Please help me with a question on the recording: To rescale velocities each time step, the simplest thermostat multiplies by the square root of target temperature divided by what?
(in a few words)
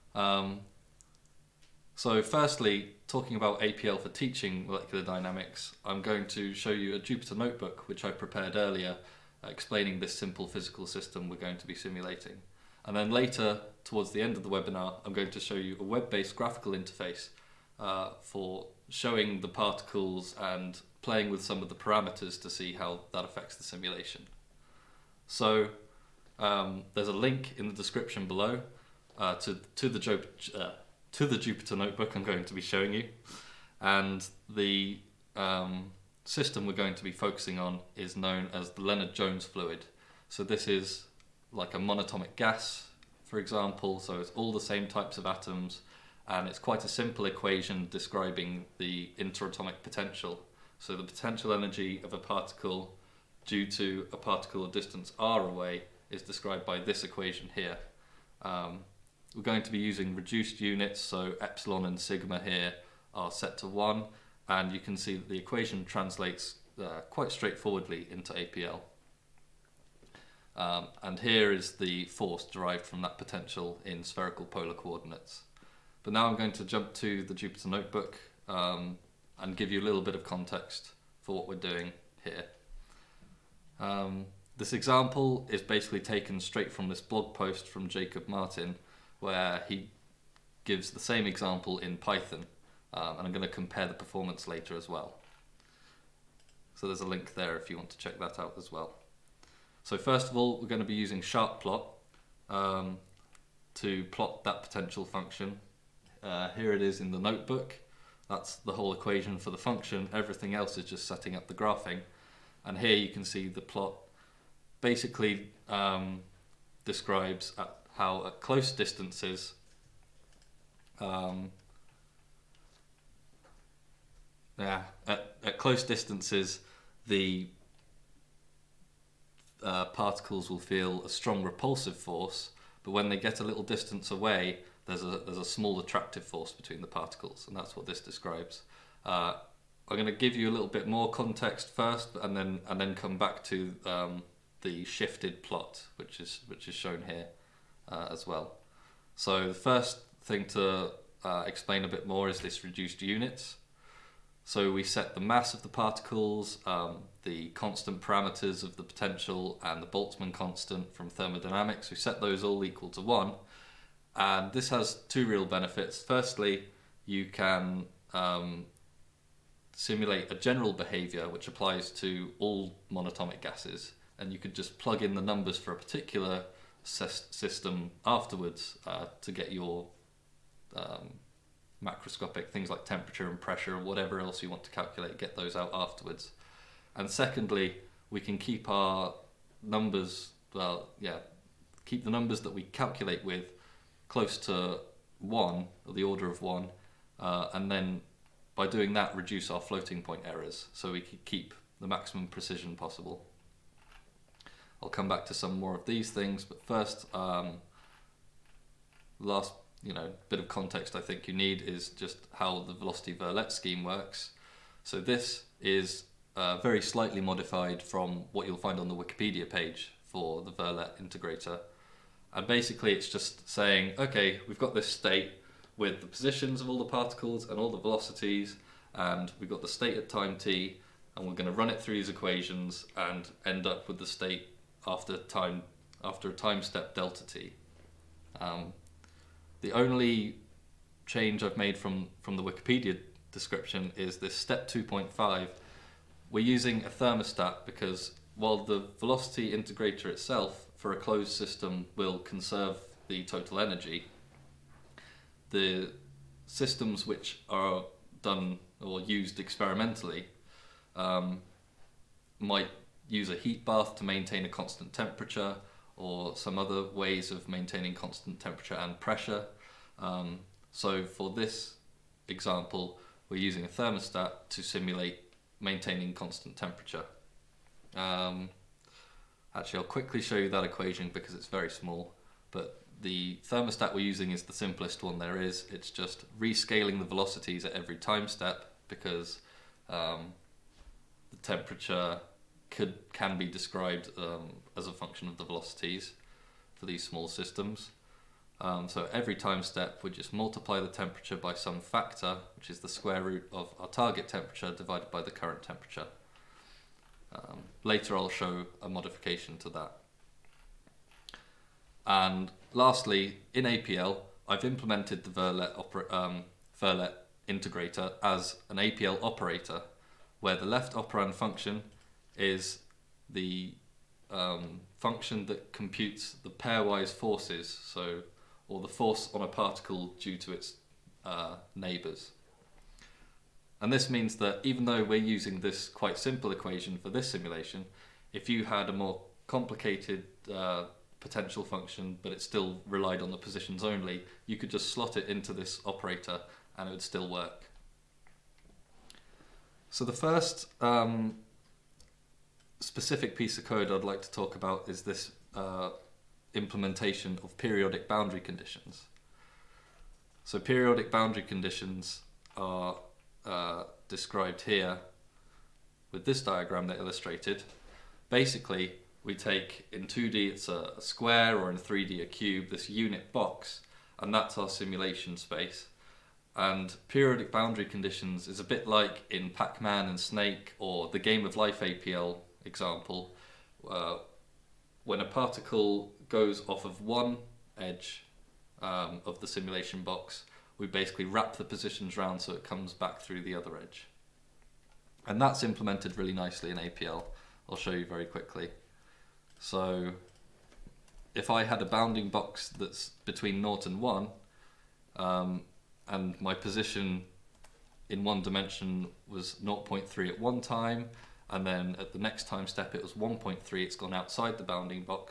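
the current temperature.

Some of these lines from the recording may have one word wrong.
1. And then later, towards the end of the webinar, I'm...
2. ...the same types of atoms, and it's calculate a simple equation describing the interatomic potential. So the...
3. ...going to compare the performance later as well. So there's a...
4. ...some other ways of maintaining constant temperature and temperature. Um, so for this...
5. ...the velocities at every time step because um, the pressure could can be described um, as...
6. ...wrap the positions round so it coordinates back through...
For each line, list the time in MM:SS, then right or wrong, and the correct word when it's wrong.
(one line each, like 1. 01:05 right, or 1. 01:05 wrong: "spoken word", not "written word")
1. 00:12 right
2. 00:44 wrong: "quite", not "calculate"
3. 01:33 right
4. 04:26 wrong: "pressure", not "temperature"
5. 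04:46 wrong: "temperature", not "pressure"
6. 06:31 wrong: "comes", not "coordinates".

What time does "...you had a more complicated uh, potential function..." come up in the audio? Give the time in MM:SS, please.
05:38.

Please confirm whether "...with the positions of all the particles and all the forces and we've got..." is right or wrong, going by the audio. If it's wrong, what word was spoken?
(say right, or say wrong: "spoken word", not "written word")
wrong: "velocities", not "forces".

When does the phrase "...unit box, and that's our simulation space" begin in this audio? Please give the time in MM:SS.
06:12.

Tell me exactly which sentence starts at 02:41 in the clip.
We set those all equal to one, and this has two real benefits.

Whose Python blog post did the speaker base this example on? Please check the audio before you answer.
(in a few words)
Jacob Martin.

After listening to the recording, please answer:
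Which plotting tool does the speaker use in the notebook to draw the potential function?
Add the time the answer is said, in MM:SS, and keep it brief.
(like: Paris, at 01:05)
SharpPlot, at 01:41.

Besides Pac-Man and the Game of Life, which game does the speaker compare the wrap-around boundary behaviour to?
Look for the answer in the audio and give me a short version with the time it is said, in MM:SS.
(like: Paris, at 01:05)
Snake, at 06:20.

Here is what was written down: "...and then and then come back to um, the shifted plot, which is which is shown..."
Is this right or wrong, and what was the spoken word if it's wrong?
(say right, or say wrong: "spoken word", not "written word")
right.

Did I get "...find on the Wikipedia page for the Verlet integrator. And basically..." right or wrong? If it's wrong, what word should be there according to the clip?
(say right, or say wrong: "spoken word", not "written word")
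right.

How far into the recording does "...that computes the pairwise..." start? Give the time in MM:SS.
05:25.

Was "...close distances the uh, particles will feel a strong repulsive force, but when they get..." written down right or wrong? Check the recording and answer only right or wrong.
right.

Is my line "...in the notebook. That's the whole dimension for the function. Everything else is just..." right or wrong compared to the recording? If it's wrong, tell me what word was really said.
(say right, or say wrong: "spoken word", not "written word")
wrong: "equation", not "dimension".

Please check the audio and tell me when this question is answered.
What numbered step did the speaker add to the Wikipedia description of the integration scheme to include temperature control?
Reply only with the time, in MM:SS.
04:04.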